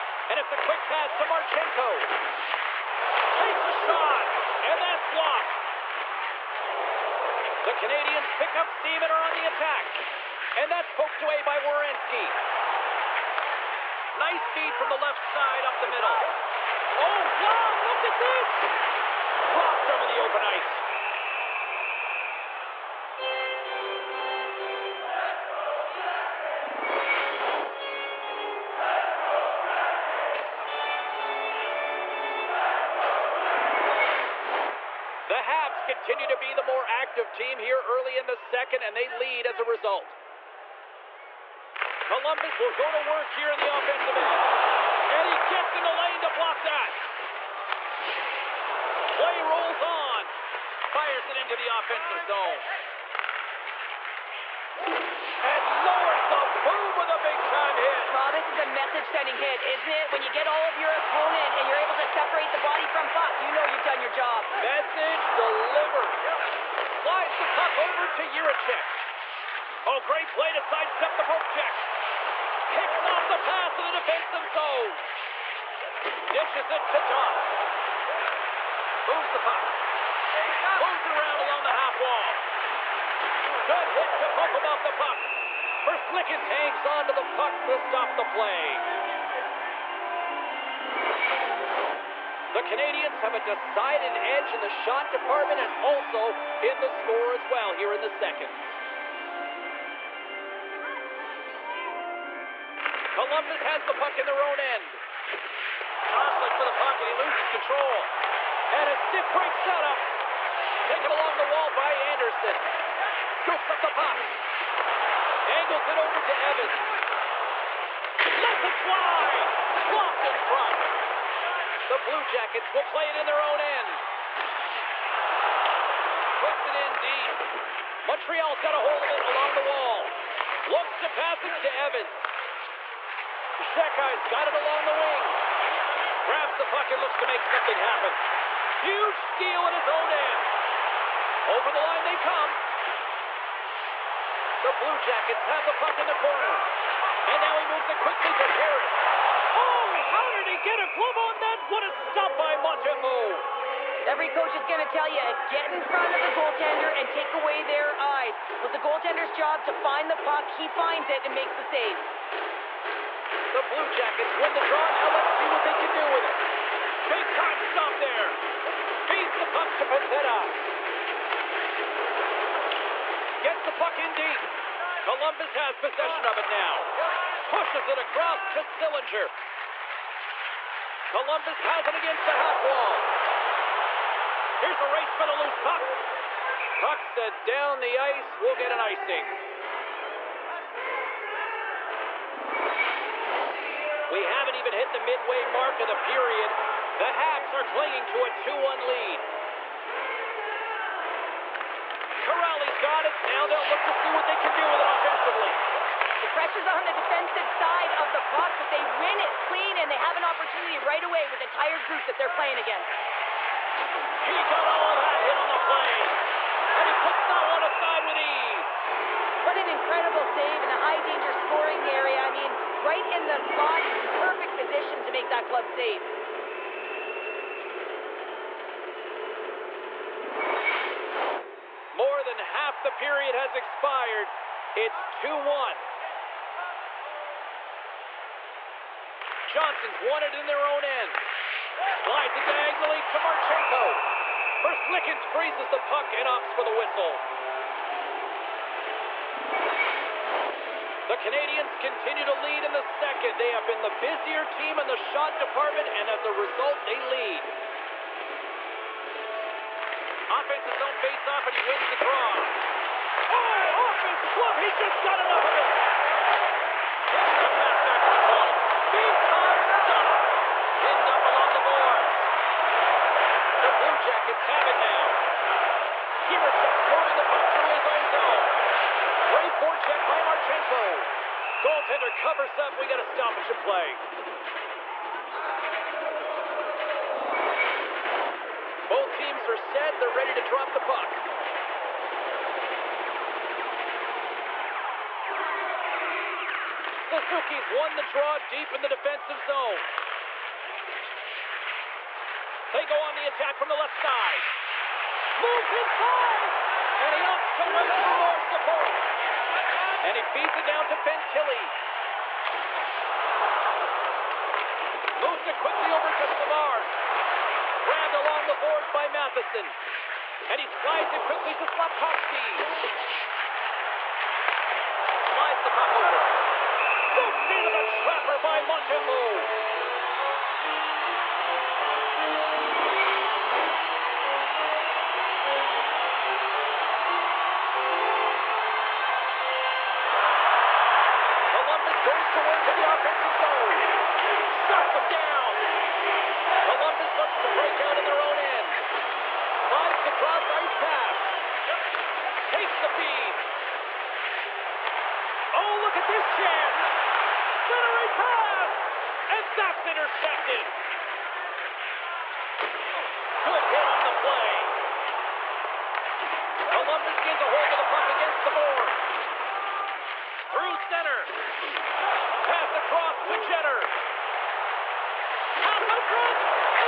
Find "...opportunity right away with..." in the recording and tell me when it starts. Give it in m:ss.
3:30.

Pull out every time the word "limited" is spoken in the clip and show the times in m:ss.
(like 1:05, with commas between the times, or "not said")
not said.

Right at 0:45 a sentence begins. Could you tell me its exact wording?
And he gets in the lane to block that.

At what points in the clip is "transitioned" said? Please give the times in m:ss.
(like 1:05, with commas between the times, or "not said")
not said.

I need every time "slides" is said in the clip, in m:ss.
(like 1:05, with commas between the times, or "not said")
1:07, 4:02, 5:20, 5:25.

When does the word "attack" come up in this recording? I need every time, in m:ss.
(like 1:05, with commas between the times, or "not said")
0:09, 5:03.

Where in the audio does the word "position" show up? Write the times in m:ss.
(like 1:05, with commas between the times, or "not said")
3:44.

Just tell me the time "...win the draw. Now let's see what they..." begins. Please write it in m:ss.
2:44.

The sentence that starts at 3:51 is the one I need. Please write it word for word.
More than half the period has expired.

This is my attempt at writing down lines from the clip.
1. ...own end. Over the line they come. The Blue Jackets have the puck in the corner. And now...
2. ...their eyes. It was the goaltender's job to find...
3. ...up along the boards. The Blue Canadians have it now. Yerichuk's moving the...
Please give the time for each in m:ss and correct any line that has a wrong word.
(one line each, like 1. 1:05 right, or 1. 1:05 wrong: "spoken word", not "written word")
1. 2:19 right
2. 2:37 right
3. 4:31 wrong: "Jackets", not "Canadians".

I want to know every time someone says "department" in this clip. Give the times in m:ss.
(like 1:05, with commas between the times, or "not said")
1:35, 4:15.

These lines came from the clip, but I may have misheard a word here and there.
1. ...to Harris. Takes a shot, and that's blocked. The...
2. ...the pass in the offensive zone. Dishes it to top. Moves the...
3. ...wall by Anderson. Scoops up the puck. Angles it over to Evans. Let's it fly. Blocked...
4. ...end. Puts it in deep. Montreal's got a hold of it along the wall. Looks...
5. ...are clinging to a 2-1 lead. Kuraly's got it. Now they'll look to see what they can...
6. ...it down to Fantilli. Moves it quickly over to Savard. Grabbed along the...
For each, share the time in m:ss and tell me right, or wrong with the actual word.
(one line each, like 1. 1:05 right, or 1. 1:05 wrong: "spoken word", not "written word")
1. 0:01 wrong: "Marchenko", not "Harris"
2. 1:13 wrong: "defensive", not "offensive"
3. 1:51 right
4. 2:03 right
5. 3:17 right
6. 5:10 right.